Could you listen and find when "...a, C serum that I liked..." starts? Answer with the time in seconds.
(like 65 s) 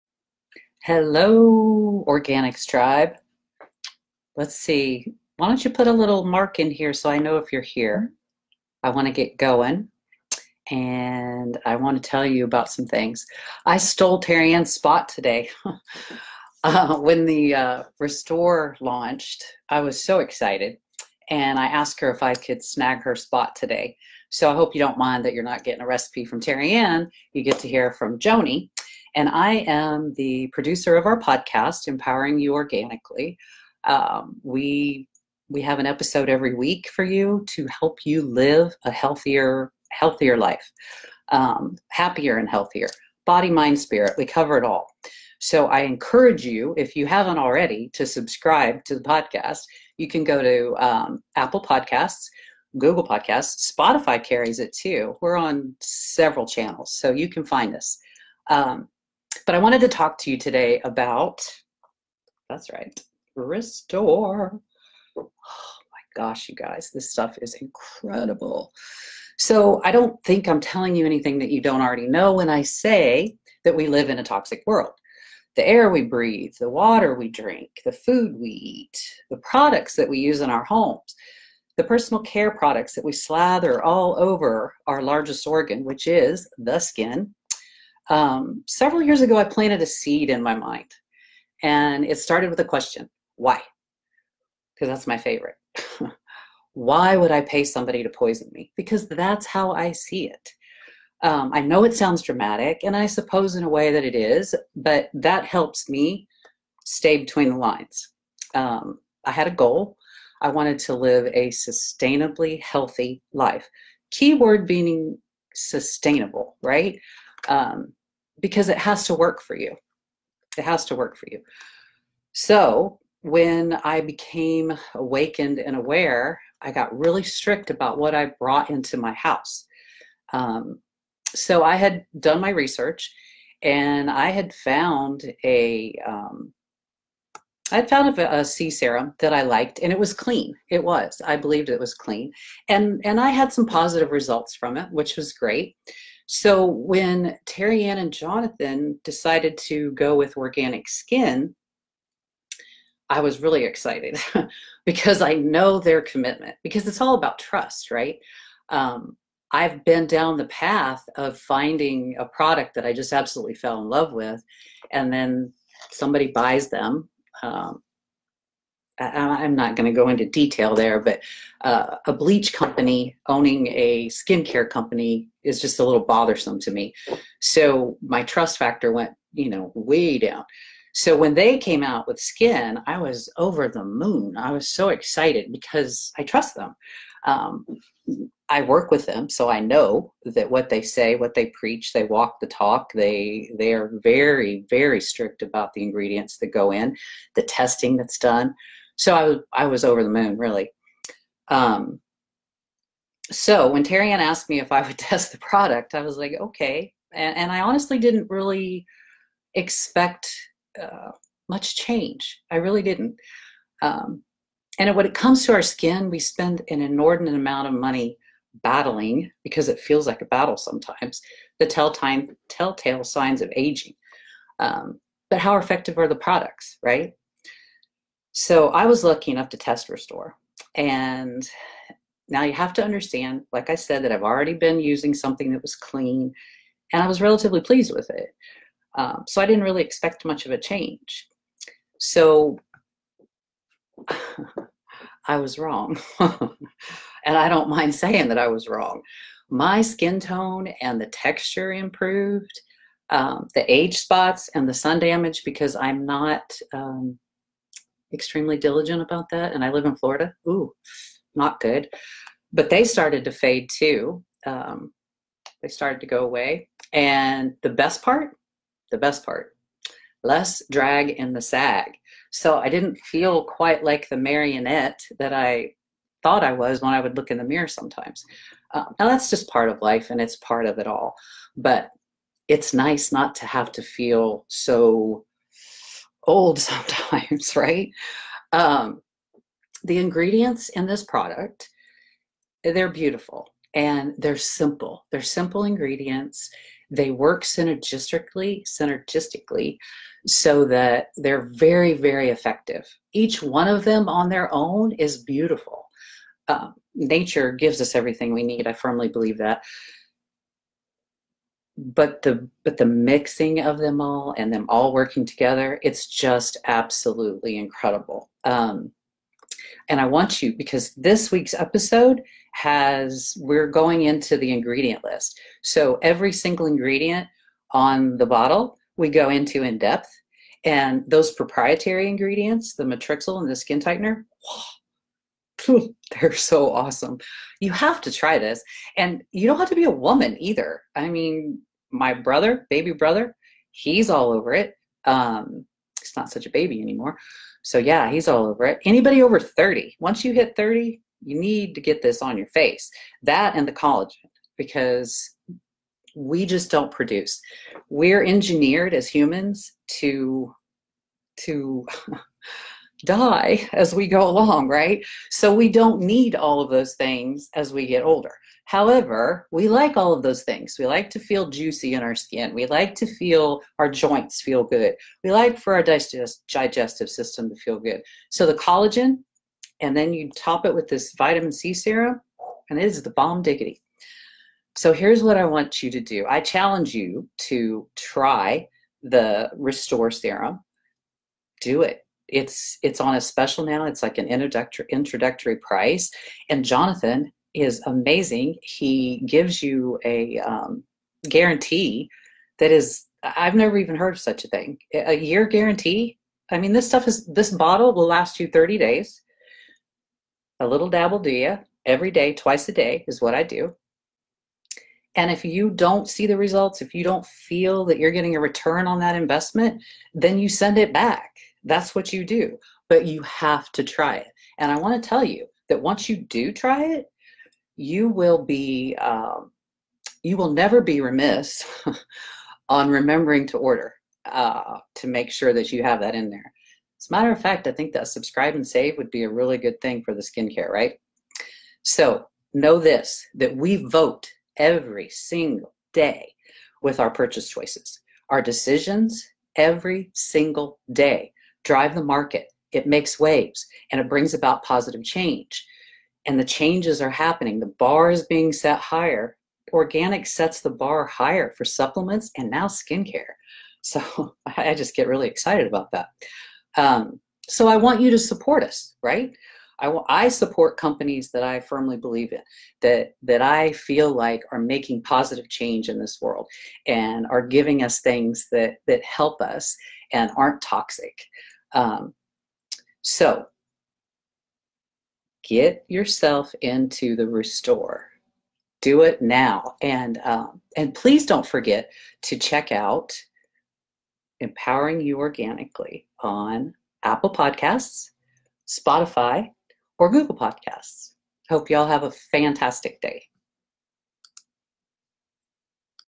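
138 s.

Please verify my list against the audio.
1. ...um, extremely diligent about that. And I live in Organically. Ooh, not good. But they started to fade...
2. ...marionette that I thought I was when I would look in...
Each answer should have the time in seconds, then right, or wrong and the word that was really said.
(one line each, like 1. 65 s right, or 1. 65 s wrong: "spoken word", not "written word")
1. 256 s wrong: "Florida", not "Organically"
2. 274 s right.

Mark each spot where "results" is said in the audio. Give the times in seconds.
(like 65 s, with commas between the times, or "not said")
144 s, 416 s.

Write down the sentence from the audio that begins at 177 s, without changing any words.
So my trust factor went, you know, way down.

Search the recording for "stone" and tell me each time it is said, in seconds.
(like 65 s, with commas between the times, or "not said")
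not said.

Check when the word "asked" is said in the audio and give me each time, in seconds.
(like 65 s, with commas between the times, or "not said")
21 s, 204 s.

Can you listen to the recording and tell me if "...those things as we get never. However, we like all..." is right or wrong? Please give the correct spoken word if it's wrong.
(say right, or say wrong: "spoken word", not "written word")
wrong: "older", not "never".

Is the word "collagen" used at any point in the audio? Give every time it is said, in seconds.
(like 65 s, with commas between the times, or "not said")
353 s, 378 s.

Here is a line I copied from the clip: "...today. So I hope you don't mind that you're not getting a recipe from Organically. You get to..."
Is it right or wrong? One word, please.
wrong.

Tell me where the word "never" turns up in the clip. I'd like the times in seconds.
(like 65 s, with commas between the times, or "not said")
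403 s, 430 s.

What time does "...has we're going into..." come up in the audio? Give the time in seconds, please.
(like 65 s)
322 s.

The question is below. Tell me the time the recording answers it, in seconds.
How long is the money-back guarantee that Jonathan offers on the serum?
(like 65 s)
404 s.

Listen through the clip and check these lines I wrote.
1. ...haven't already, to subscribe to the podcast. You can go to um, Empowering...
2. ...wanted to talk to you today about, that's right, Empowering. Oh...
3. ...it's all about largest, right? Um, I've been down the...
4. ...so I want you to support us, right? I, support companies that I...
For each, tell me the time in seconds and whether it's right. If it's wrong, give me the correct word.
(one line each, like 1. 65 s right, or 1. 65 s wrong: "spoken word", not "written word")
1. 47 s wrong: "Apple", not "Empowering"
2. 59 s wrong: "Restore", not "Empowering"
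3. 156 s wrong: "trust", not "largest"
4. 467 s right.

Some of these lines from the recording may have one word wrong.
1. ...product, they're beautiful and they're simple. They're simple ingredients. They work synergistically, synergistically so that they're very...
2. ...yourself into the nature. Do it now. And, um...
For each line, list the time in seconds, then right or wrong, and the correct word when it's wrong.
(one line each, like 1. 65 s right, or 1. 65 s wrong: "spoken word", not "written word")
1. 291 s right
2. 485 s wrong: "restore", not "nature".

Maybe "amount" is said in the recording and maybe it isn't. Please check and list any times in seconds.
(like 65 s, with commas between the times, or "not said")
217 s.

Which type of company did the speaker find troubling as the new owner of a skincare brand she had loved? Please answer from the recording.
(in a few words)
A bleach company.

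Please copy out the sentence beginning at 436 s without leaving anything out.
As a matter of fact, I think that subscribe and save would be a really good thing for the skincare, right?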